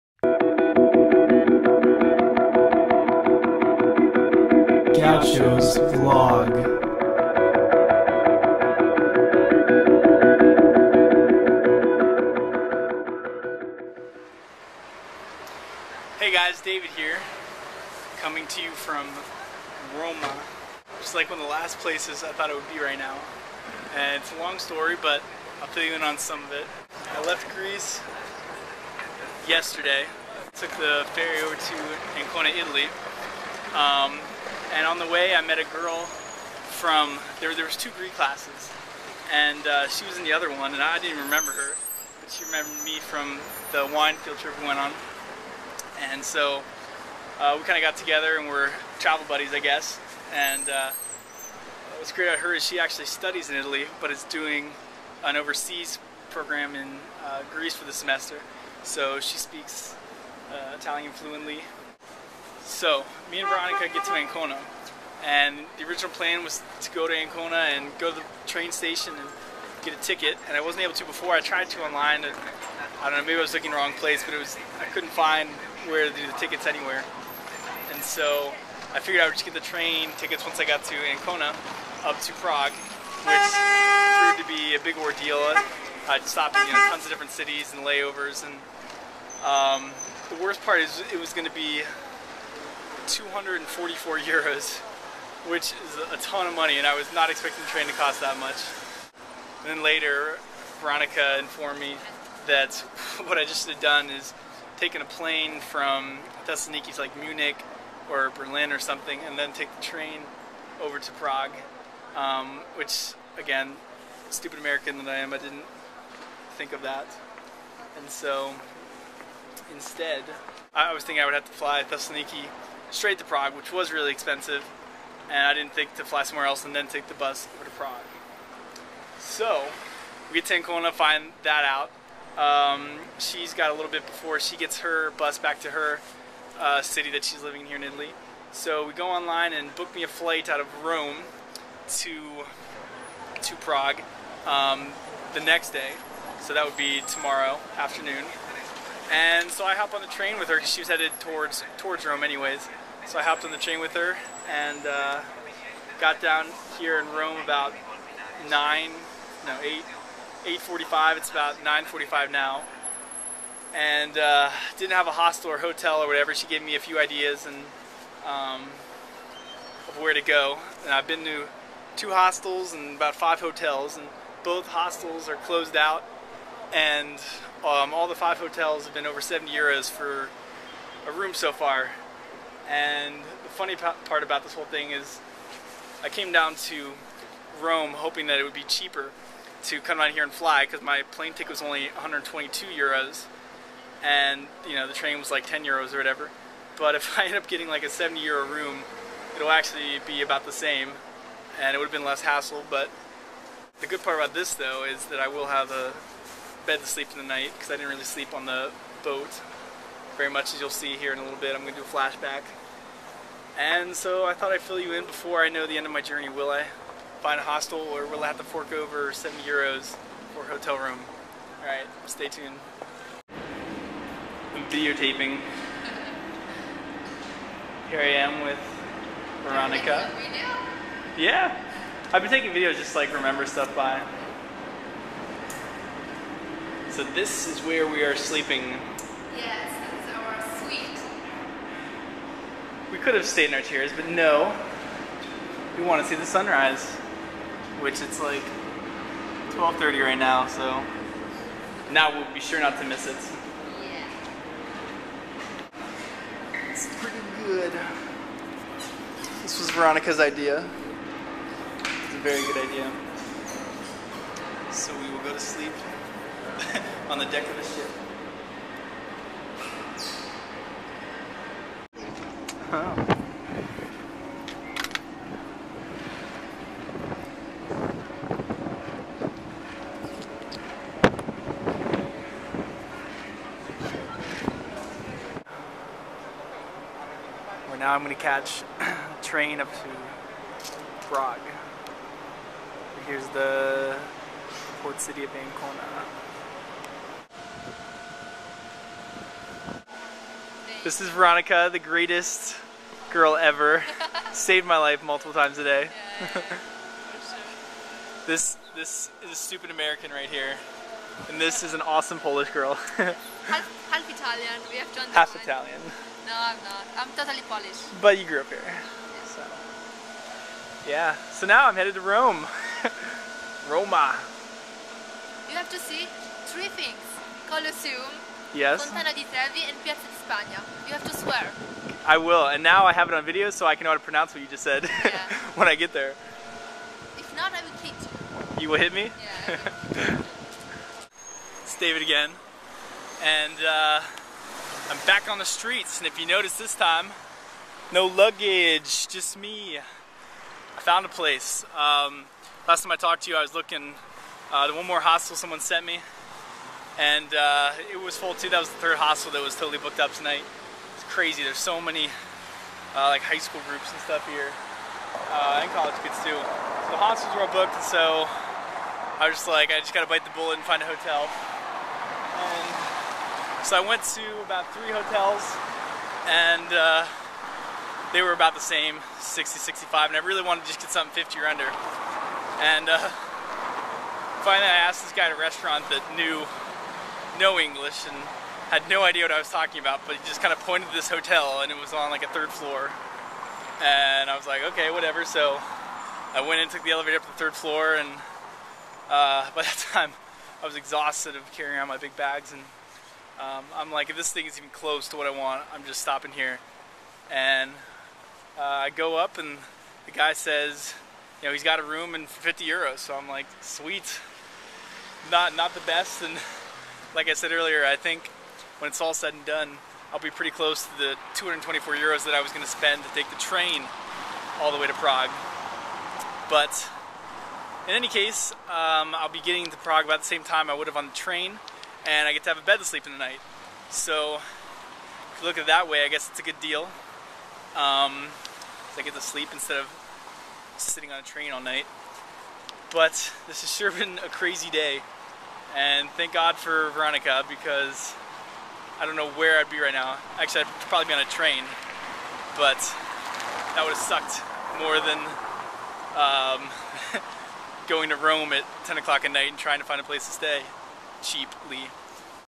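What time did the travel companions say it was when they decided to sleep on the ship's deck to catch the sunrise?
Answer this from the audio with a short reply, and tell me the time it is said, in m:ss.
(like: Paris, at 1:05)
12:30, at 4:09.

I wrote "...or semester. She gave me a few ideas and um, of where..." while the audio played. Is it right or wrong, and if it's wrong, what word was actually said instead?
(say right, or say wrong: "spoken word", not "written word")
wrong: "whatever", not "semester".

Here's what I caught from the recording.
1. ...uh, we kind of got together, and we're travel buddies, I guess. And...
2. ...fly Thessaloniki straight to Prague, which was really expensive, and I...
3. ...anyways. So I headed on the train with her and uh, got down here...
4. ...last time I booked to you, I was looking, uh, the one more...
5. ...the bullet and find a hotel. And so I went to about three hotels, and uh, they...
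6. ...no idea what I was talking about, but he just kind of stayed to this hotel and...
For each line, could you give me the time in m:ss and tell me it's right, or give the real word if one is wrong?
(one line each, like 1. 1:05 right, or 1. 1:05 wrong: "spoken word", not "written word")
1. 0:47 right
2. 2:01 right
3. 2:32 wrong: "hopped", not "headed"
4. 5:52 wrong: "talked", not "booked"
5. 6:10 right
6. 6:28 wrong: "pointed", not "stayed".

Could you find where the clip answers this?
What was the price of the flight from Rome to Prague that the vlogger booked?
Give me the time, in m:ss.
3:11.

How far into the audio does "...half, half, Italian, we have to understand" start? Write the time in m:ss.
5:12.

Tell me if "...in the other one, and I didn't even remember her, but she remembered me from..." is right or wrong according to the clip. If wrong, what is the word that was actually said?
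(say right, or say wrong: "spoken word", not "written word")
right.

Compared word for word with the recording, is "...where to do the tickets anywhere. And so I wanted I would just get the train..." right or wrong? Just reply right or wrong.
wrong.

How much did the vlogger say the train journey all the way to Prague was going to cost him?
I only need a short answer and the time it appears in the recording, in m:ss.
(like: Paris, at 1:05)
244 euros, at 1:33.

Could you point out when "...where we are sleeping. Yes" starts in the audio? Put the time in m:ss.
3:57.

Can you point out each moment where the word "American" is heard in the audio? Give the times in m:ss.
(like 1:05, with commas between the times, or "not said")
1:54, 5:09.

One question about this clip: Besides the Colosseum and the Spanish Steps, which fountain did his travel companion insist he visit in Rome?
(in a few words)
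Fontana di Trevi.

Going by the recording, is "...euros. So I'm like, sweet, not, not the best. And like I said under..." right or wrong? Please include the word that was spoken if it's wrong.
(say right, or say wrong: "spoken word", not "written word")
wrong: "earlier", not "under".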